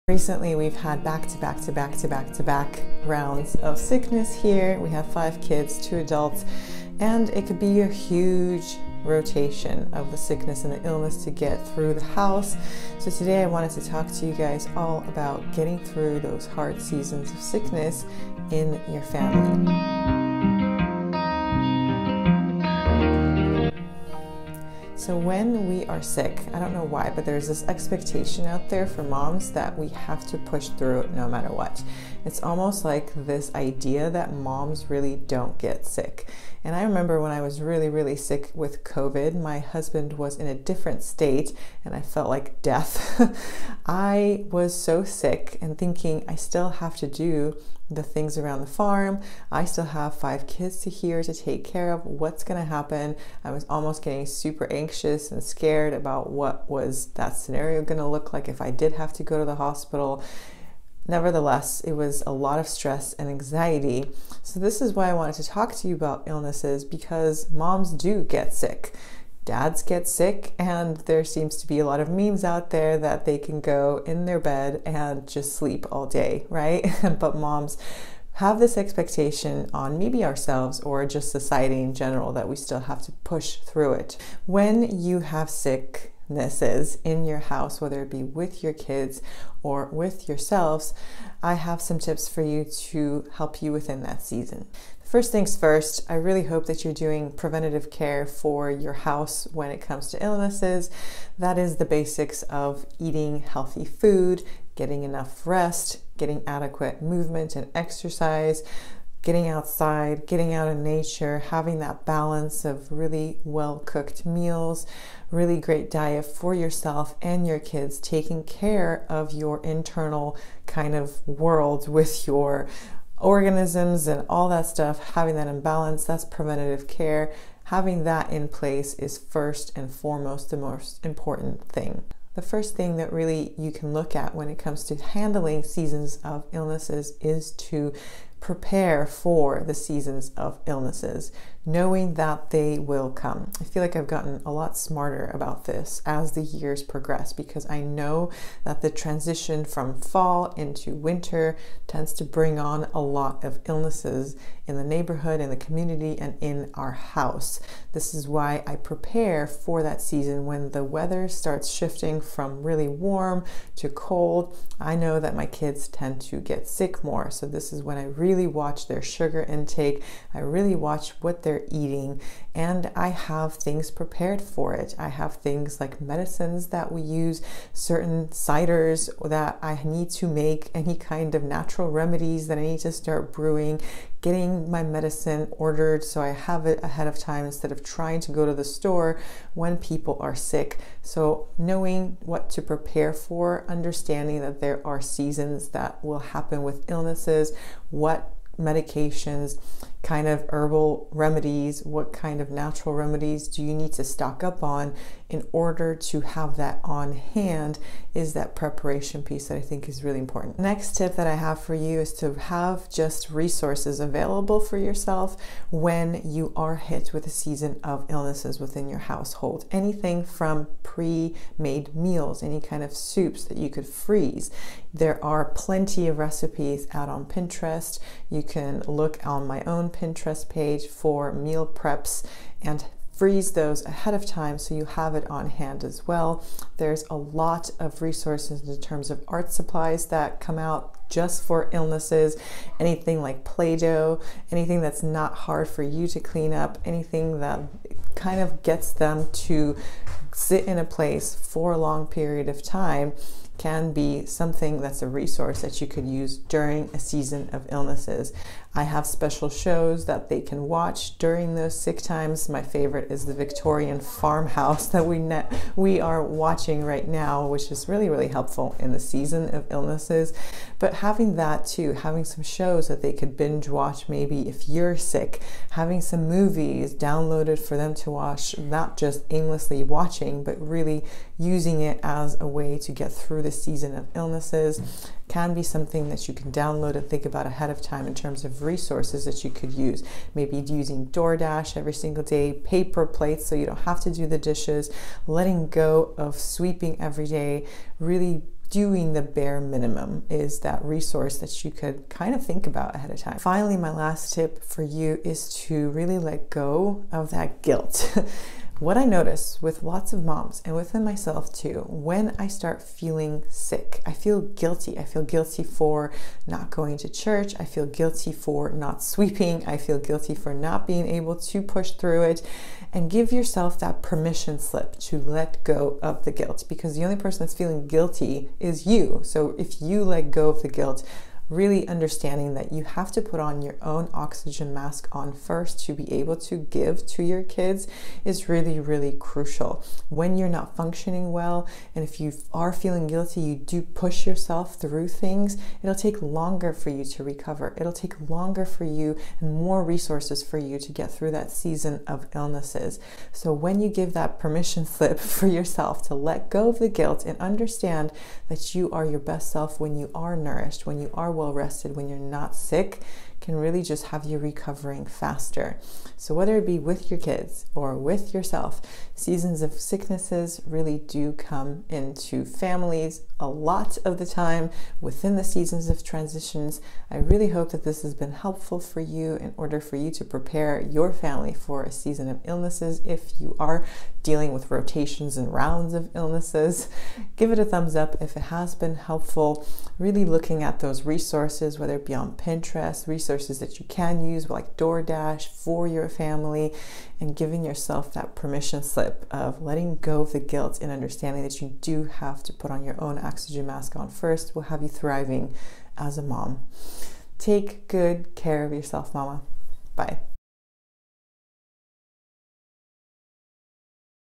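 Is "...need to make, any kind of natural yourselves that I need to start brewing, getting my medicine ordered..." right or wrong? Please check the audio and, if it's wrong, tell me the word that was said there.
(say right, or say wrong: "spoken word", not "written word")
wrong: "remedies", not "yourselves".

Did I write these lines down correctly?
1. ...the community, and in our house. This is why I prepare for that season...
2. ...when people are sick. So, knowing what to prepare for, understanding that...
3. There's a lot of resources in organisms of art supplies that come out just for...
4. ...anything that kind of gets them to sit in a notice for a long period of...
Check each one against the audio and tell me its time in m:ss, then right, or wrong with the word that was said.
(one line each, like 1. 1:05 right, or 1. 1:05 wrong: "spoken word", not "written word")
1. 2:35 right
2. 3:09 right
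3. 3:56 wrong: "terms", not "organisms"
4. 4:06 wrong: "place", not "notice".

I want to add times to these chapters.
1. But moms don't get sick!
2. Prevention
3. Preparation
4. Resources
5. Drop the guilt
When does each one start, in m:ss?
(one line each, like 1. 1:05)
1. 0:32
2. 1:38
3. 2:17
4. 3:34
5. 5:08.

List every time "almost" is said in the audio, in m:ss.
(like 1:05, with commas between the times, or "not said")
0:32, 0:53.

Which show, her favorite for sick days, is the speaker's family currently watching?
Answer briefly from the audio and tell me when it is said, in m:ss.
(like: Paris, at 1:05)
Victorian farmhouse, at 4:23.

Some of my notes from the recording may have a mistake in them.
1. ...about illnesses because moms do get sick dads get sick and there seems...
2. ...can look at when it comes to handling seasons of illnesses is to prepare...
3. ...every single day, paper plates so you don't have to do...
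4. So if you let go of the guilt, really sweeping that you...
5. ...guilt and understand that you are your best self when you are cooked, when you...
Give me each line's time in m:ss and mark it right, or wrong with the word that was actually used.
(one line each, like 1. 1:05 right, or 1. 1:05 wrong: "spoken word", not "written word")
1. 1:05 right
2. 2:13 right
3. 4:51 right
4. 5:29 wrong: "understanding", not "sweeping"
5. 5:56 wrong: "nourished", not "cooked".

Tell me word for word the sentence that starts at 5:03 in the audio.
Finally, my last tip for you is to really let go of that guilt.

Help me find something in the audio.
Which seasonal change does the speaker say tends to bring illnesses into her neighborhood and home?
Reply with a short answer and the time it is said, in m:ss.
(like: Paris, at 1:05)
Fall into winter, at 2:30.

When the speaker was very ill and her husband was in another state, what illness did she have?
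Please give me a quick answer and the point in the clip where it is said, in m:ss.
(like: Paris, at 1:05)
COVID, at 0:38.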